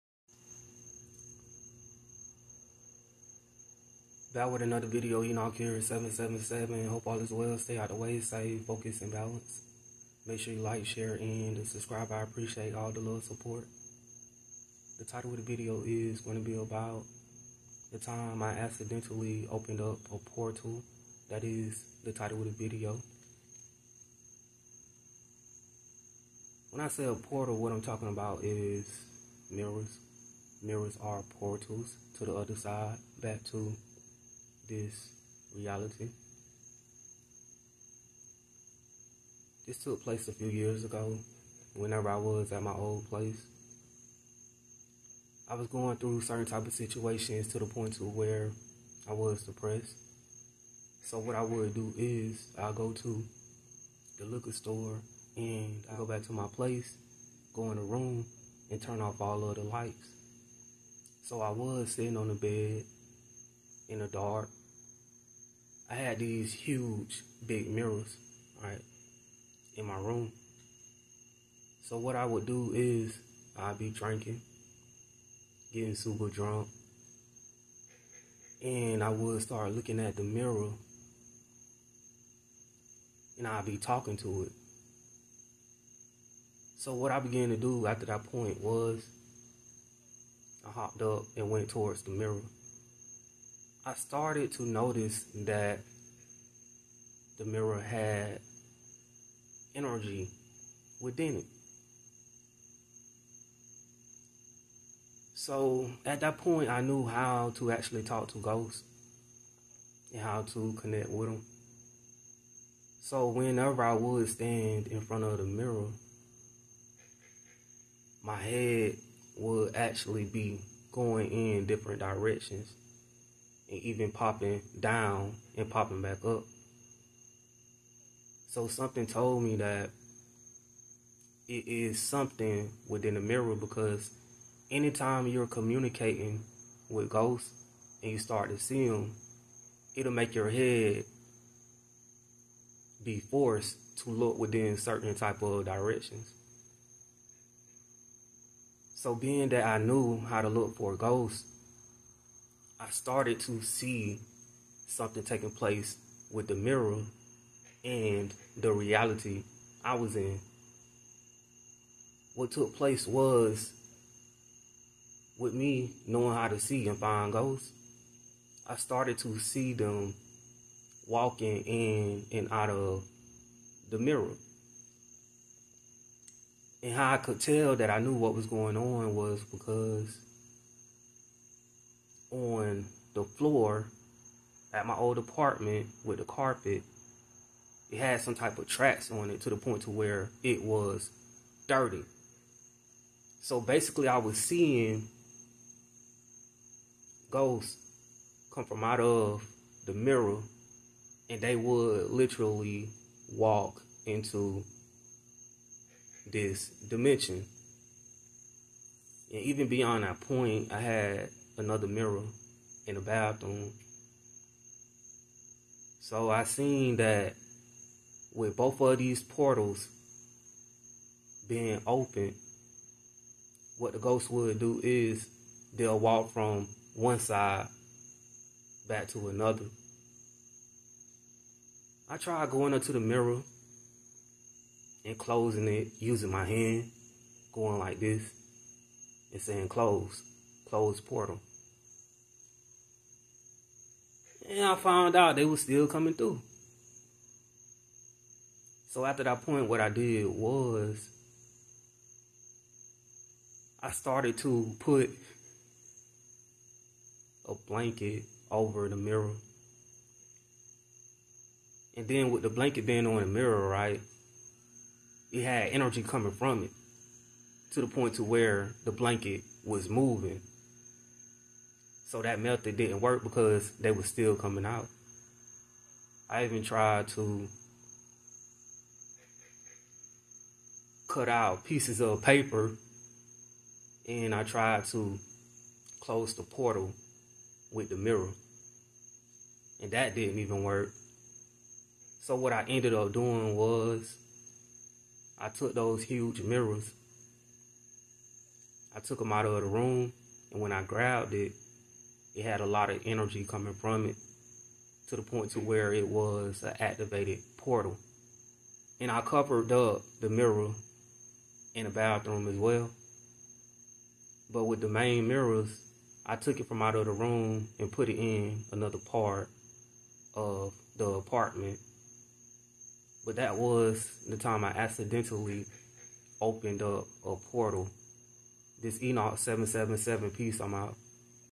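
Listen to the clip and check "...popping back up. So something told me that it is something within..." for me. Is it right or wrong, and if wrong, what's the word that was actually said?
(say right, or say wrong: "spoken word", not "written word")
right.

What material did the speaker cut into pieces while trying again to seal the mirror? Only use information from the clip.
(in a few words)
paper.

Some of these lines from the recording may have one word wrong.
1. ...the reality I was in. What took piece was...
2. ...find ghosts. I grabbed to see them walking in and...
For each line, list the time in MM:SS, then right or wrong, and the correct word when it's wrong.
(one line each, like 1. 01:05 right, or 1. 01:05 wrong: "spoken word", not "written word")
1. 02:38 wrong: "place", not "piece"
2. 02:46 wrong: "started", not "grabbed".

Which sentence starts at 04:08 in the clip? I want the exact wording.
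So after that point, what I did was I started to put a blanket over the mirror.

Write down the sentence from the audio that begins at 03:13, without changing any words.
So basically, I was seeing ghosts come from out of the mirror, and they would literally walk into this dimension.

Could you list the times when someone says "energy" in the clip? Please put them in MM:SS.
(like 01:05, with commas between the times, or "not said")
01:39, 04:25, 05:03.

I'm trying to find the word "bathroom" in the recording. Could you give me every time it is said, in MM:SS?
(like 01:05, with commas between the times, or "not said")
03:33, 05:11.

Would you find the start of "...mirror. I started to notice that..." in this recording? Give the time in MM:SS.
01:32.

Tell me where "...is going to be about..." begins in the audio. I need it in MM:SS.
00:15.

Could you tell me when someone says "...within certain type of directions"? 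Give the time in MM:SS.
02:24.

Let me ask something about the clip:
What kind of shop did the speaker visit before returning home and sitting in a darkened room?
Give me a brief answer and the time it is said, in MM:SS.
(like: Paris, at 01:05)
liquor store, at 00:54.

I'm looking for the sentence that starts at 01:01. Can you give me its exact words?
So I was sitting on the bed in the dark I had these huge big mirrors, right, in my room.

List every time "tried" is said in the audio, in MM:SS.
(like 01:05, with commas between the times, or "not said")
03:52, 04:36, 04:44.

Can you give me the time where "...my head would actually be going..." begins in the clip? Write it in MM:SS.
01:58.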